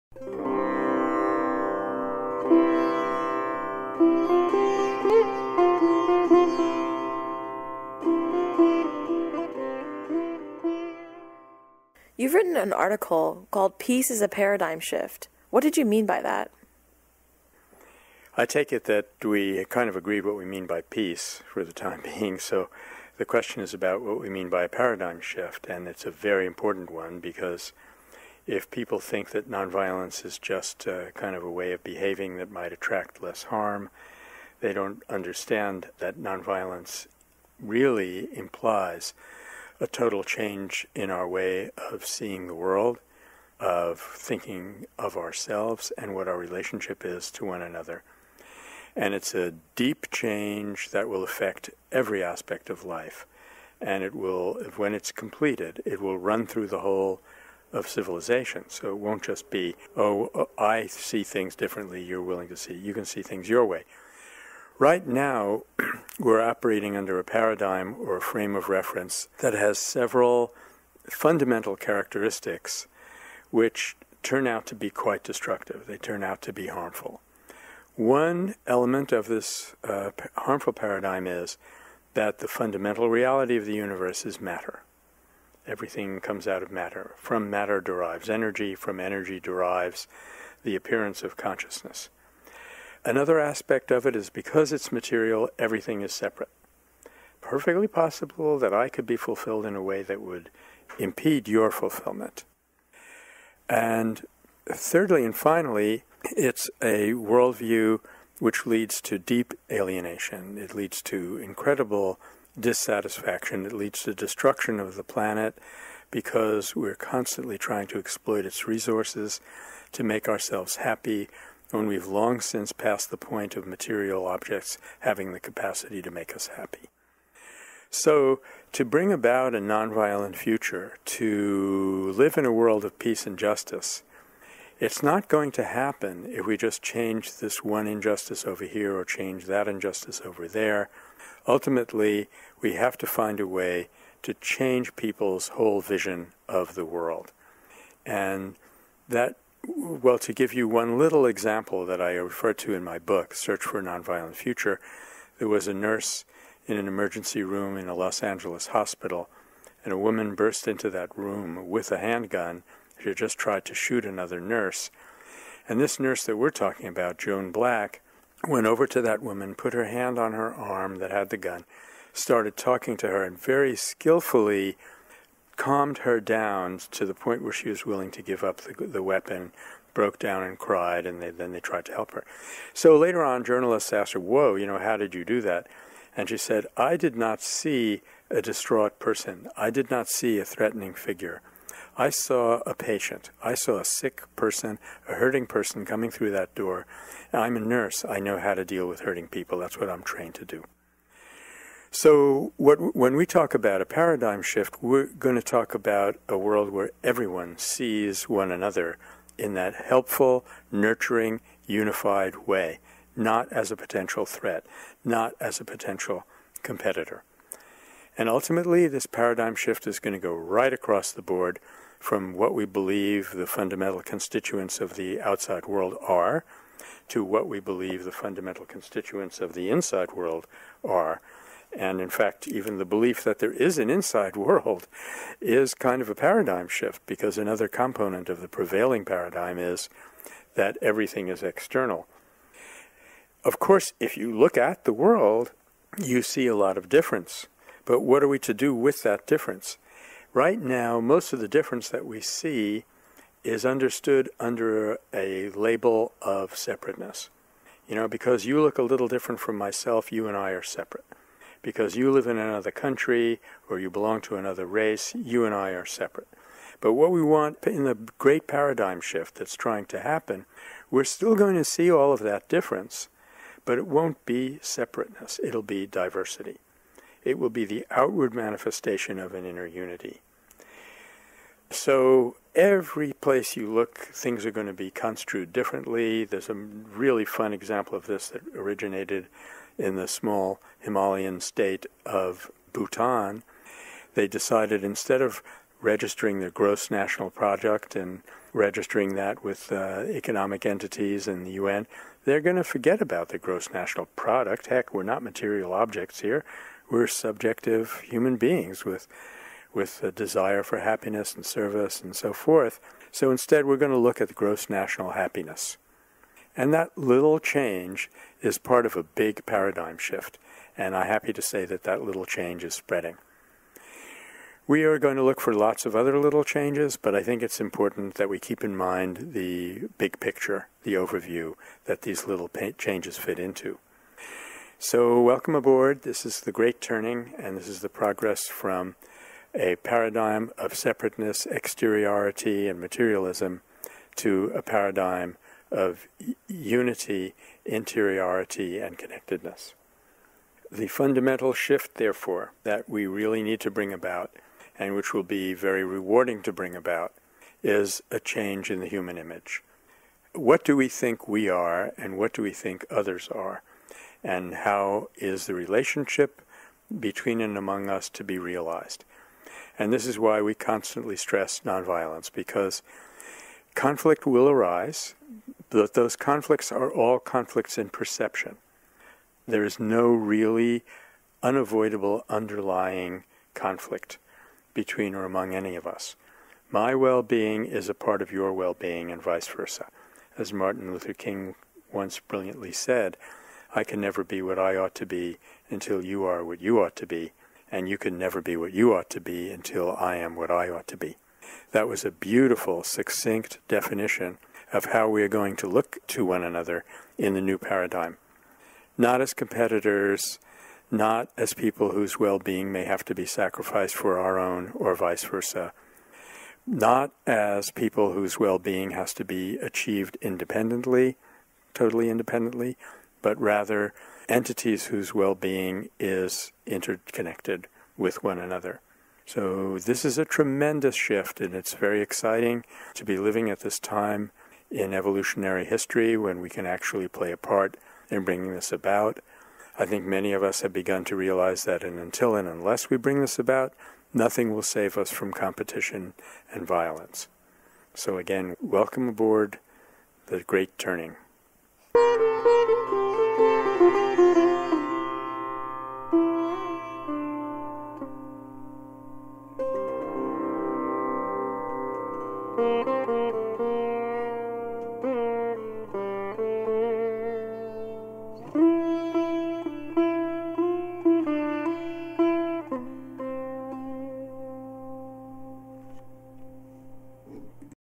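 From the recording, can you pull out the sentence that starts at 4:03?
Of course, if you look at the world, you see a lot of difference.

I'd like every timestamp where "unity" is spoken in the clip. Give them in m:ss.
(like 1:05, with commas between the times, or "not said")
4:39, 5:46.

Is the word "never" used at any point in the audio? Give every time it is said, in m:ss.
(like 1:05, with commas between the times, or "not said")
6:34, 6:38.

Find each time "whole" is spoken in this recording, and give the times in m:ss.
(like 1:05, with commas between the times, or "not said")
0:56, 2:25.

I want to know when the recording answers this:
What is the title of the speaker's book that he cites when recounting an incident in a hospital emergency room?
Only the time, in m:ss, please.
2:33.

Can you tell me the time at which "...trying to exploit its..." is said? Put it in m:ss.
1:57.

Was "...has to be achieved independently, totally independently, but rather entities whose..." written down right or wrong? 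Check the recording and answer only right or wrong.
right.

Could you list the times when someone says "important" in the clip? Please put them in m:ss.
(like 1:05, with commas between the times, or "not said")
0:26, 5:27.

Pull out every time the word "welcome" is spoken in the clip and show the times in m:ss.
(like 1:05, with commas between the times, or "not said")
5:35, 7:28.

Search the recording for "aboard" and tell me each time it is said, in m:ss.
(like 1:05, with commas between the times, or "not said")
5:35, 7:29.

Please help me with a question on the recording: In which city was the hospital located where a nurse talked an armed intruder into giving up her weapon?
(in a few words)
Los Angeles.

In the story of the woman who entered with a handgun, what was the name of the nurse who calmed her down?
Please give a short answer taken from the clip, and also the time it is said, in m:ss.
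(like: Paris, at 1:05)
Joan Black, at 2:47.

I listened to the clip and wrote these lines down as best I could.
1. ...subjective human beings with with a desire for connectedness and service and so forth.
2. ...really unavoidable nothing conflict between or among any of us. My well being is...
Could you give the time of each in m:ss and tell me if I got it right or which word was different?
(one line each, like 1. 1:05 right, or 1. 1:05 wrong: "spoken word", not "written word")
1. 5:07 wrong: "happiness", not "connectedness"
2. 6:20 wrong: "underlying", not "nothing".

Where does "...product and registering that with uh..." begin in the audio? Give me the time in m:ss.
4:57.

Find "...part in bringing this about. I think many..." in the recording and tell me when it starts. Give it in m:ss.
7:17.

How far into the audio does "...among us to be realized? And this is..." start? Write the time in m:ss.
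6:07.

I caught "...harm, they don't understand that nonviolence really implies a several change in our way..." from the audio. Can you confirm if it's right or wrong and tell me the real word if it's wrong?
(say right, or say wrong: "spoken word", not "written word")
wrong: "total", not "several".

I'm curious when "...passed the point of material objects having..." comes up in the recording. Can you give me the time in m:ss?
2:02.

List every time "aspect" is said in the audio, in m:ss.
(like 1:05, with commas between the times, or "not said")
0:52, 1:33.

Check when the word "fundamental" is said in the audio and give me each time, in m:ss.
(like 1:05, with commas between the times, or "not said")
1:11, 1:22, 3:43, 3:48, 5:50.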